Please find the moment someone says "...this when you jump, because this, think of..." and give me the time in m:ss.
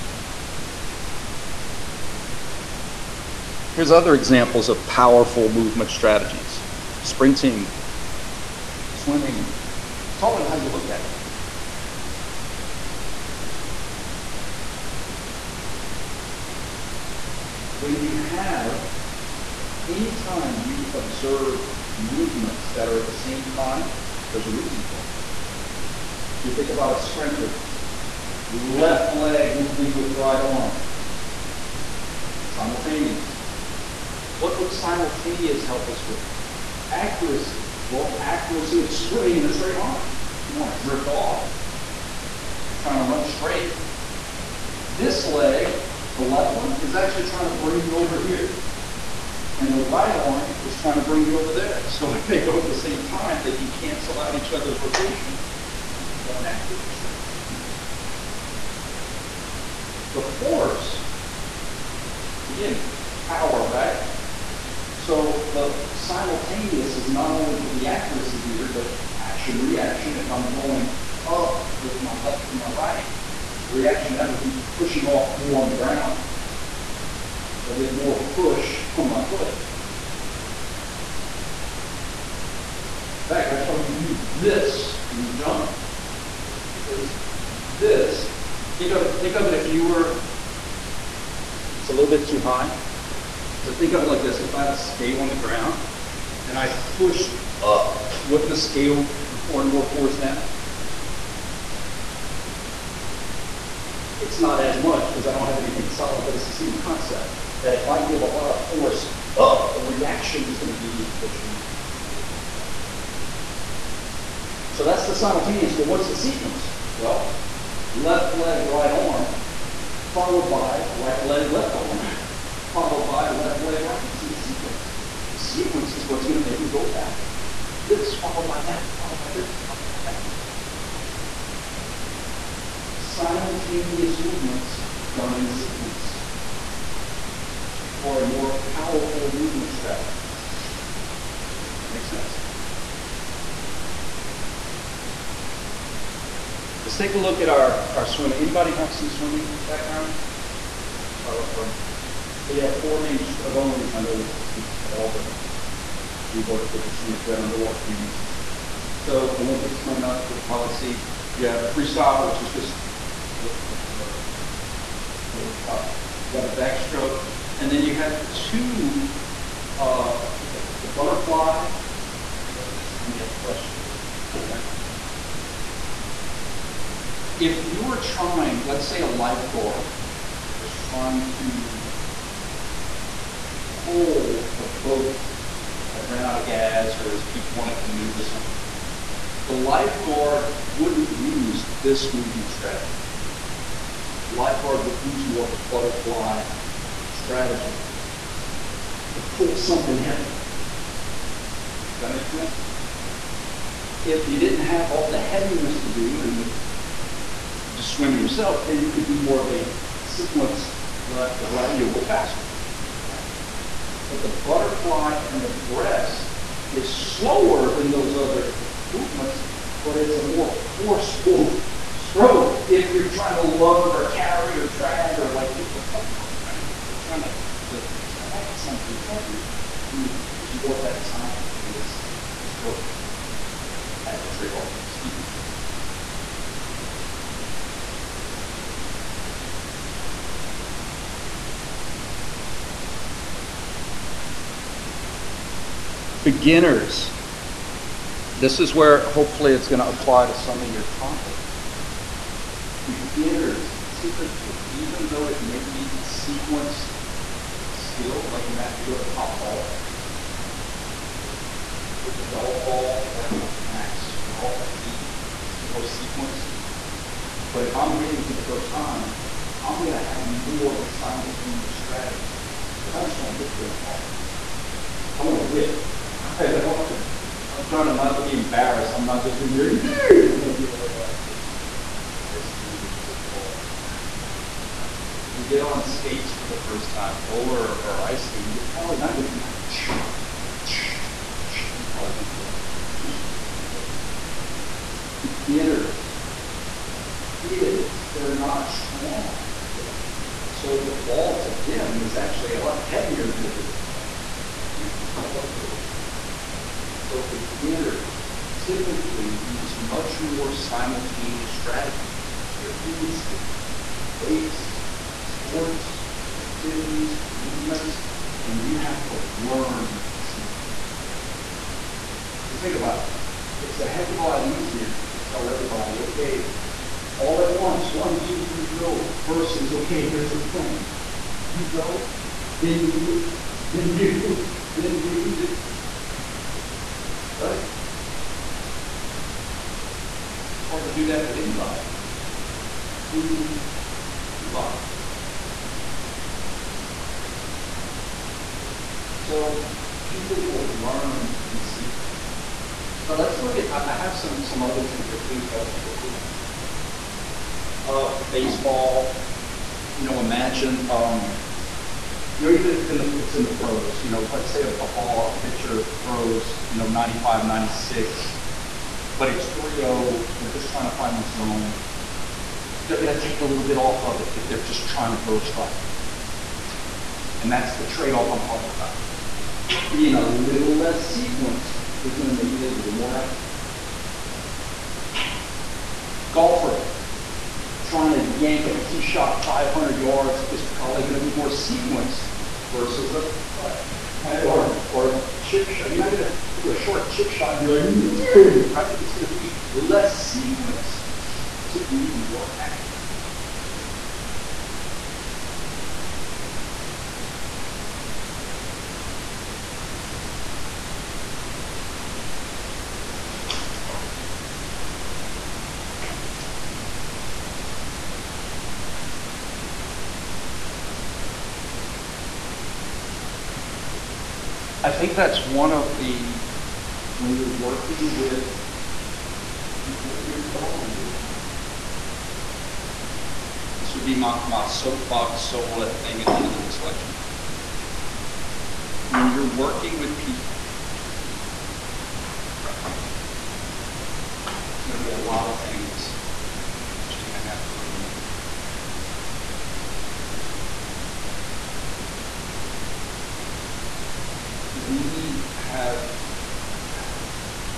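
1:24.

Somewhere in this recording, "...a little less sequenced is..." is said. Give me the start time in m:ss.
6:20.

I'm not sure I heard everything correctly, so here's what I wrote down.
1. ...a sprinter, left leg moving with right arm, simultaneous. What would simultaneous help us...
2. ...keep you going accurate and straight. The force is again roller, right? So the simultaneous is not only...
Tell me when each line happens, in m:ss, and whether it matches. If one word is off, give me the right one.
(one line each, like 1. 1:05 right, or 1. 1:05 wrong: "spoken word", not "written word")
1. 0:26 right
2. 0:55 wrong: "power", not "roller".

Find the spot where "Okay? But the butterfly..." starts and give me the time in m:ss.
3:33.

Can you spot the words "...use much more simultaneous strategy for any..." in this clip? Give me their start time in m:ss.
5:09.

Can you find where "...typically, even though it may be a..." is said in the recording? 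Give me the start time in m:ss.
4:13.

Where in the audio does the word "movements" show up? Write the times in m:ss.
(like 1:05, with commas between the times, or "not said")
0:05, 0:21, 2:14, 2:19, 3:12, 3:38, 5:17.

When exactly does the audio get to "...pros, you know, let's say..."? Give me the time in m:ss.
6:03.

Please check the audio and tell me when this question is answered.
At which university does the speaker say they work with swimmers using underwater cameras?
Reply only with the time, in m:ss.
2:34.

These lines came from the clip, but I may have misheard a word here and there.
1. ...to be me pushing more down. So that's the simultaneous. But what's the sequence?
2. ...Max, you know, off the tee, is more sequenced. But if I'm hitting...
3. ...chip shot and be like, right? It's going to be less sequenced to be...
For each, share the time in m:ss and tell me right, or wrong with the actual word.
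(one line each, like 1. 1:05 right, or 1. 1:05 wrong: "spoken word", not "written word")
1. 1:50 right
2. 4:23 right
3. 6:37 right.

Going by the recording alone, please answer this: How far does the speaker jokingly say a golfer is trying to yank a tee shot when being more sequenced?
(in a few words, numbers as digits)
500 yards.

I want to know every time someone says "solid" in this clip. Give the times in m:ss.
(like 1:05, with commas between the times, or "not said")
1:45.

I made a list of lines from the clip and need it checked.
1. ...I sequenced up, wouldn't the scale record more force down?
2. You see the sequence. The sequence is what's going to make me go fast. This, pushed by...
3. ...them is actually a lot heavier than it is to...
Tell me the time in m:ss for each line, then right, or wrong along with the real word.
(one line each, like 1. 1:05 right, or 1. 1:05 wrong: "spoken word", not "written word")
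1. 1:36 wrong: "pushed", not "sequenced"
2. 2:04 wrong: "followed", not "pushed"
3. 5:01 right.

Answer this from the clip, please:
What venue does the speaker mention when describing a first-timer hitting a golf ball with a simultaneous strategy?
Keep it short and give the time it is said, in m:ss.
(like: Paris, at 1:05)
Top golf, at 4:19.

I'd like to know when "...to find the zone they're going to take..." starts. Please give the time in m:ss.
6:10.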